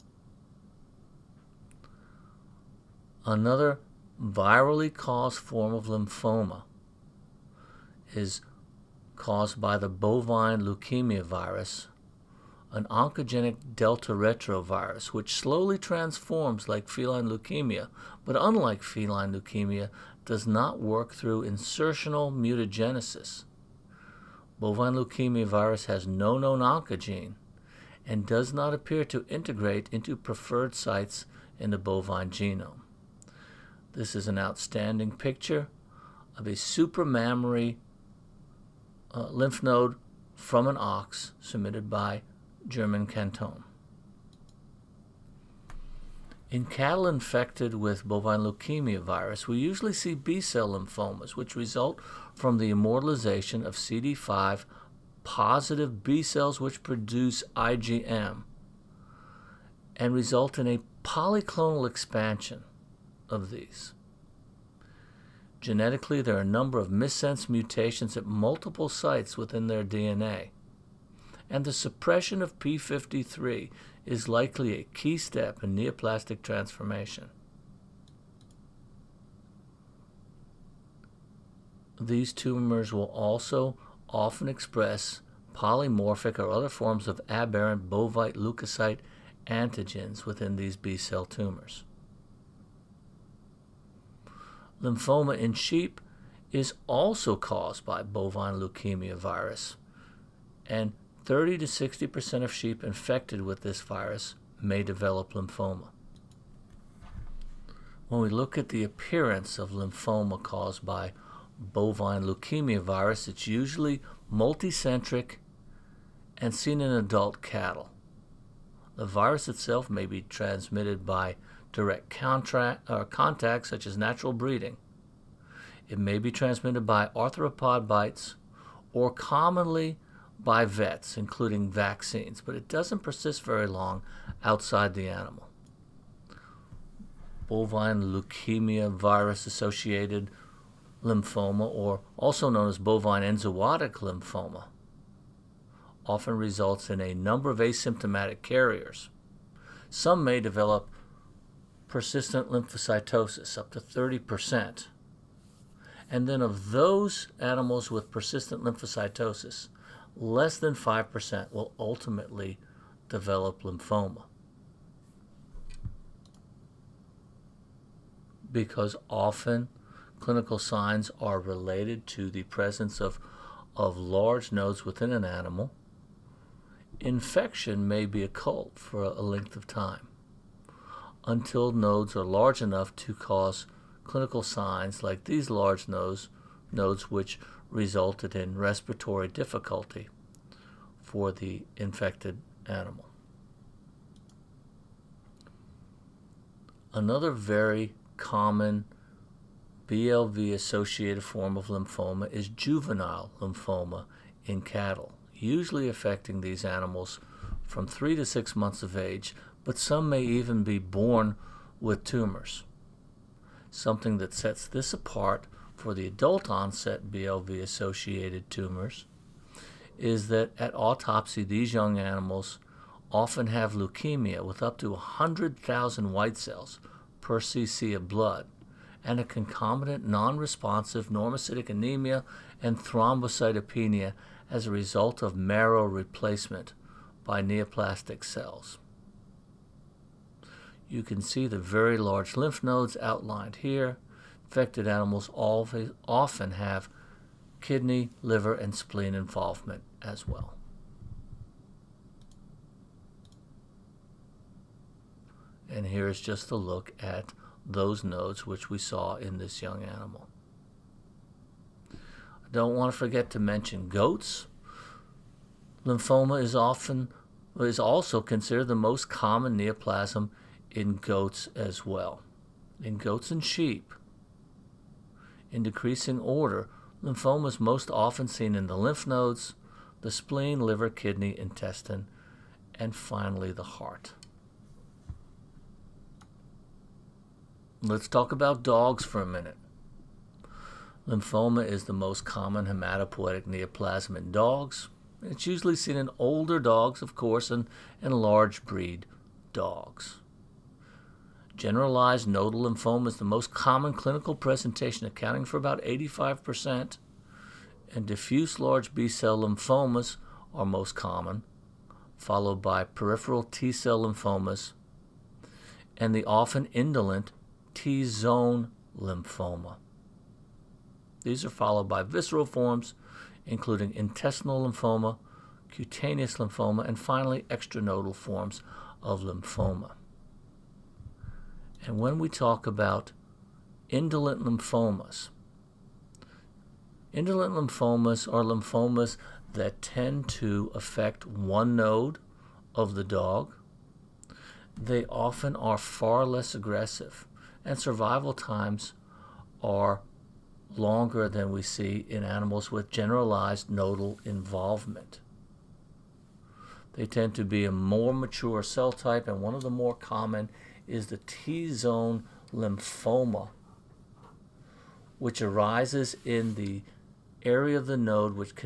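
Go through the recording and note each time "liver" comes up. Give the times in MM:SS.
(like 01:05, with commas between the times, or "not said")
04:08, 04:40.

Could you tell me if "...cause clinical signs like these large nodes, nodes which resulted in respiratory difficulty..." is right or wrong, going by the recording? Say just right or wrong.
right.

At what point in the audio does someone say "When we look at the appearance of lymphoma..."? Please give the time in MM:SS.
01:48.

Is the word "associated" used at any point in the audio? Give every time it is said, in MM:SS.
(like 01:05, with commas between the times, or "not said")
02:19, 03:20, 03:37.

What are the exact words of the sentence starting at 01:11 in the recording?
And the suppression of P53 is likely a key step in neoplastic transformation.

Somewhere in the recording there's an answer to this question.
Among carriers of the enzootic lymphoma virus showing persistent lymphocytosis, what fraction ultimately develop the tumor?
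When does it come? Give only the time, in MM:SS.
02:40.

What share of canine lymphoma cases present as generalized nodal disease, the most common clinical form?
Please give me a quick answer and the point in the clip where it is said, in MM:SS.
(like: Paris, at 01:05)
85%, at 05:05.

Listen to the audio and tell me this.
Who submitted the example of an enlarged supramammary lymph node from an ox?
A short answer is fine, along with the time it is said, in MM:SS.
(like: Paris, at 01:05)
German Canton, at 00:42.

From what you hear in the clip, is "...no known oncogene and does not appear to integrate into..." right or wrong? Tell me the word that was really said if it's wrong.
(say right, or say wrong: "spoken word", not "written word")
right.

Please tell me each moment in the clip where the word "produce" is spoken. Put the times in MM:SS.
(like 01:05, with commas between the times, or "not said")
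00:56.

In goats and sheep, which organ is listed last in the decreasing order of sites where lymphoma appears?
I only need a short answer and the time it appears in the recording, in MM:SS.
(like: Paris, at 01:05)
heart, at 04:43.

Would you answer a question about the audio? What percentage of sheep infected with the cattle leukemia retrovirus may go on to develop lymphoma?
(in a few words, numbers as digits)
30 to 60 percent.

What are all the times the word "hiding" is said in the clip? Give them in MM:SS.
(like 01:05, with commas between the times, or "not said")
not said.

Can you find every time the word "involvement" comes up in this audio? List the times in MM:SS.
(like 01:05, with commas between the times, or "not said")
04:09, 05:54.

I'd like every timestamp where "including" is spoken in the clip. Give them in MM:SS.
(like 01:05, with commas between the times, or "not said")
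02:11, 05:23.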